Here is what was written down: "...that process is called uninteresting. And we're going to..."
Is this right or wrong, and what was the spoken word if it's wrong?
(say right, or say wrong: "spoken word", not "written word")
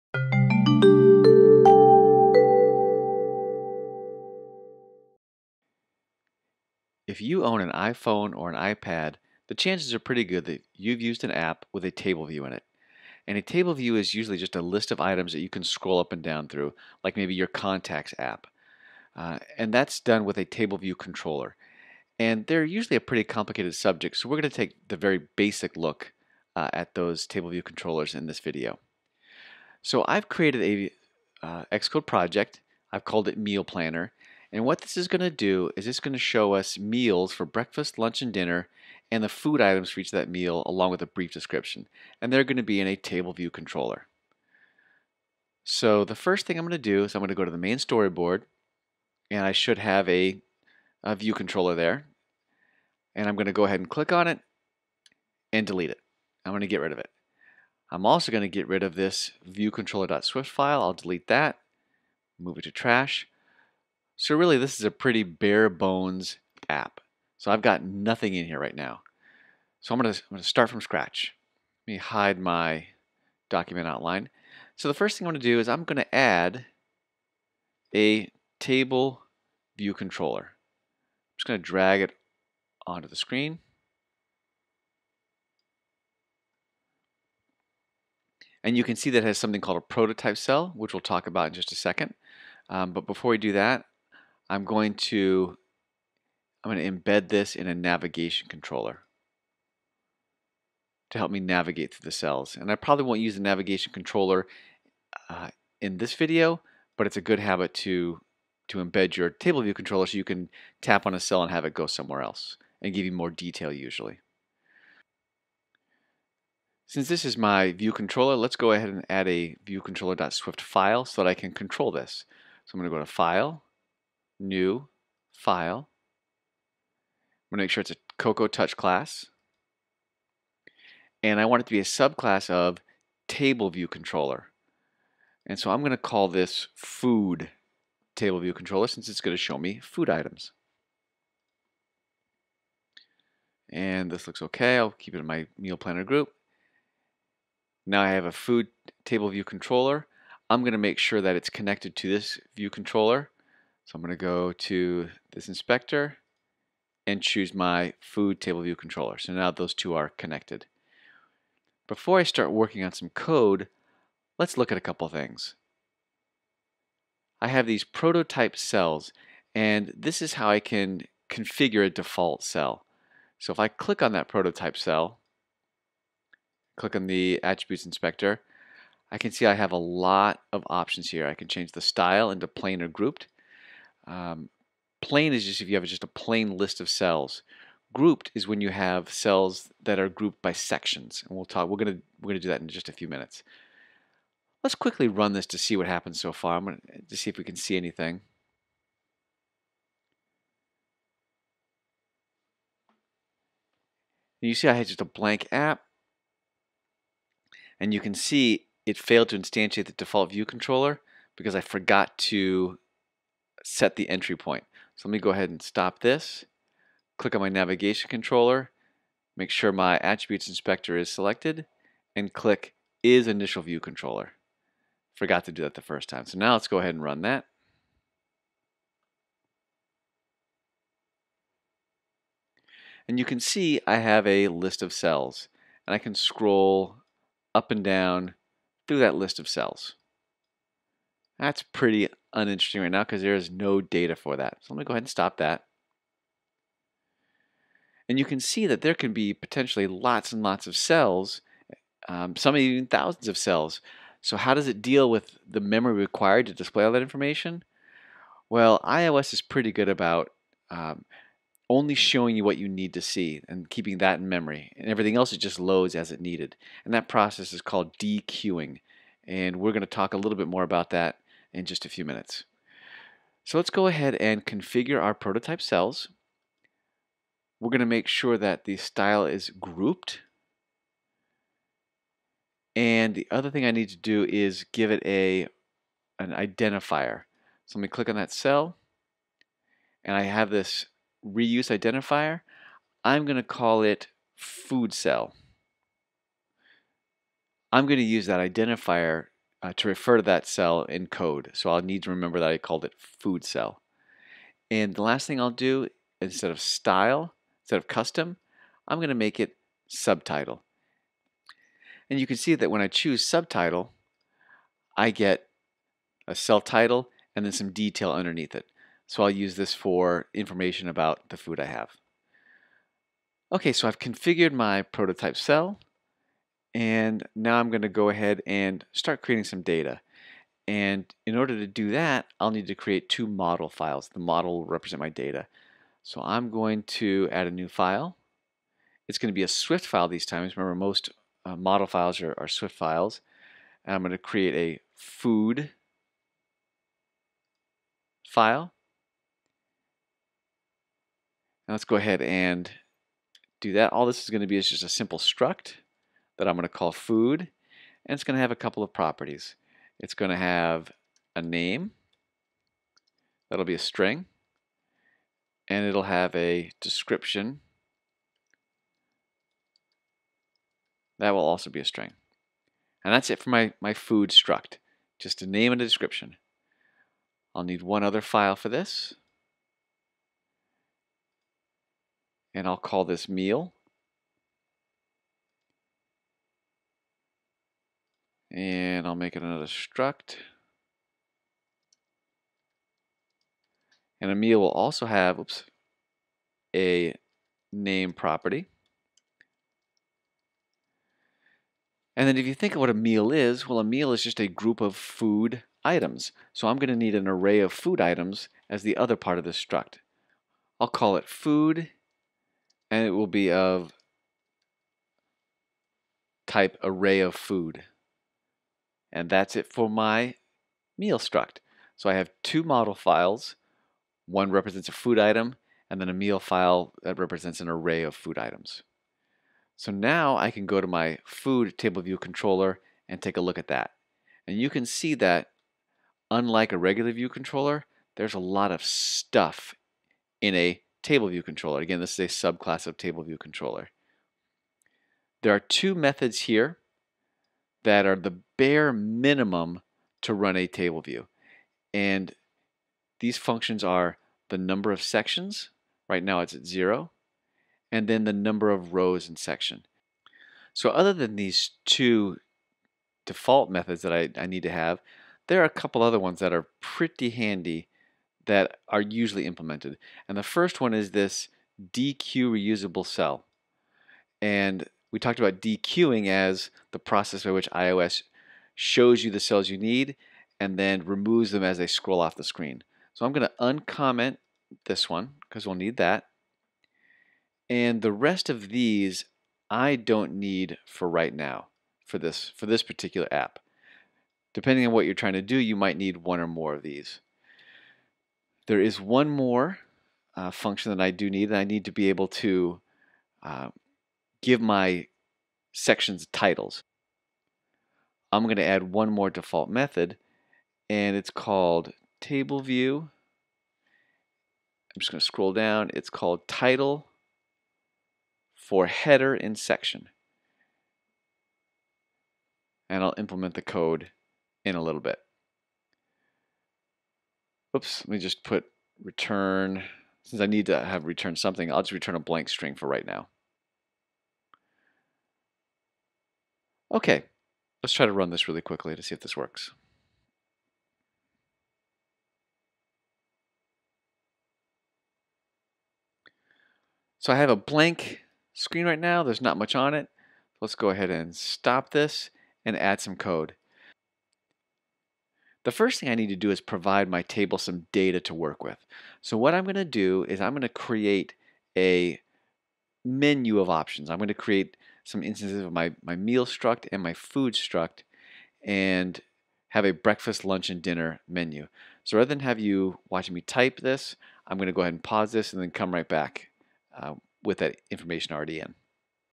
wrong: "dequeuing", not "uninteresting".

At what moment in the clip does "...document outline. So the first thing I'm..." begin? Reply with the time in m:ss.
1:13.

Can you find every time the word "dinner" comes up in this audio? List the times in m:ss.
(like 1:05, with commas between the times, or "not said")
0:38, 9:30.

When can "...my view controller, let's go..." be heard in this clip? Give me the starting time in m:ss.
1:57.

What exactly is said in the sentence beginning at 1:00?
I'll delete that, move it to trash.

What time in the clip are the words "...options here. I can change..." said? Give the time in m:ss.
3:00.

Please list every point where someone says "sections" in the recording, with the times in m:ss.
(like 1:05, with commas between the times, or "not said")
3:10, 7:35, 7:39, 8:25, 8:39.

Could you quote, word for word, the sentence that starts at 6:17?
I'll need one other file for this.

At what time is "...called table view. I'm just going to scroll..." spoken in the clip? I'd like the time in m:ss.
8:31.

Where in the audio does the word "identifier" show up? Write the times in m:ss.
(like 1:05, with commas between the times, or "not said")
4:46, 4:51, 4:58.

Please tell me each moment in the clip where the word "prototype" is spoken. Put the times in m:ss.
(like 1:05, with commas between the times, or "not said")
1:29, 2:47, 2:54, 4:35, 5:24.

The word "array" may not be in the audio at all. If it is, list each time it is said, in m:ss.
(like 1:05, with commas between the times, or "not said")
6:47, 6:56, 7:07.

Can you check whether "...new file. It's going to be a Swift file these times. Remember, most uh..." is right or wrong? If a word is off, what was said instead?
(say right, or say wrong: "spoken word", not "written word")
right.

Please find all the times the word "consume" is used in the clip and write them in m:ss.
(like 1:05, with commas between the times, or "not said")
not said.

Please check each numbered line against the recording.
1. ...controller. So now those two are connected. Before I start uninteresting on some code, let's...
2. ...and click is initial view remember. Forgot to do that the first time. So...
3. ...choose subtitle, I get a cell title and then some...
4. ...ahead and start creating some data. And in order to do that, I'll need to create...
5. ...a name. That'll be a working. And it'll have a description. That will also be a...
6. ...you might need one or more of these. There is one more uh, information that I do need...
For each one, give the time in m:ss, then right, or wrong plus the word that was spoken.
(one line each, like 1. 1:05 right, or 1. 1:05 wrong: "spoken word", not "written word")
1. 2:38 wrong: "working", not "uninteresting"
2. 3:42 wrong: "controller", not "remember"
3. 5:12 right
4. 5:28 right
5. 6:01 wrong: "string", not "working"
6. 8:15 wrong: "function", not "information".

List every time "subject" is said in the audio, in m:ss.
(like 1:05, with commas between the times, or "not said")
0:23.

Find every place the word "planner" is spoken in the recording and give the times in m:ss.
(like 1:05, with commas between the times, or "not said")
0:33, 2:25.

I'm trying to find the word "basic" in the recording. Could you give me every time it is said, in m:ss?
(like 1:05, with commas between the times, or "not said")
0:25.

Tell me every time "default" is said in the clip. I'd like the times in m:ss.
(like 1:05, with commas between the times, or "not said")
2:51, 3:29, 7:43, 8:29.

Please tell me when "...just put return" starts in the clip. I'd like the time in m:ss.
8:48.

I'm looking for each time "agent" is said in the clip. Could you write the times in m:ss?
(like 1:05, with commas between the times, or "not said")
not said.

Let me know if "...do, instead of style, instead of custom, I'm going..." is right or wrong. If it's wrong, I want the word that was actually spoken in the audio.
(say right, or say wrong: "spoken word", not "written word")
right.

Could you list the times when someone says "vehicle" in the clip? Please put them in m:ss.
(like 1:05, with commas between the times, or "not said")
not said.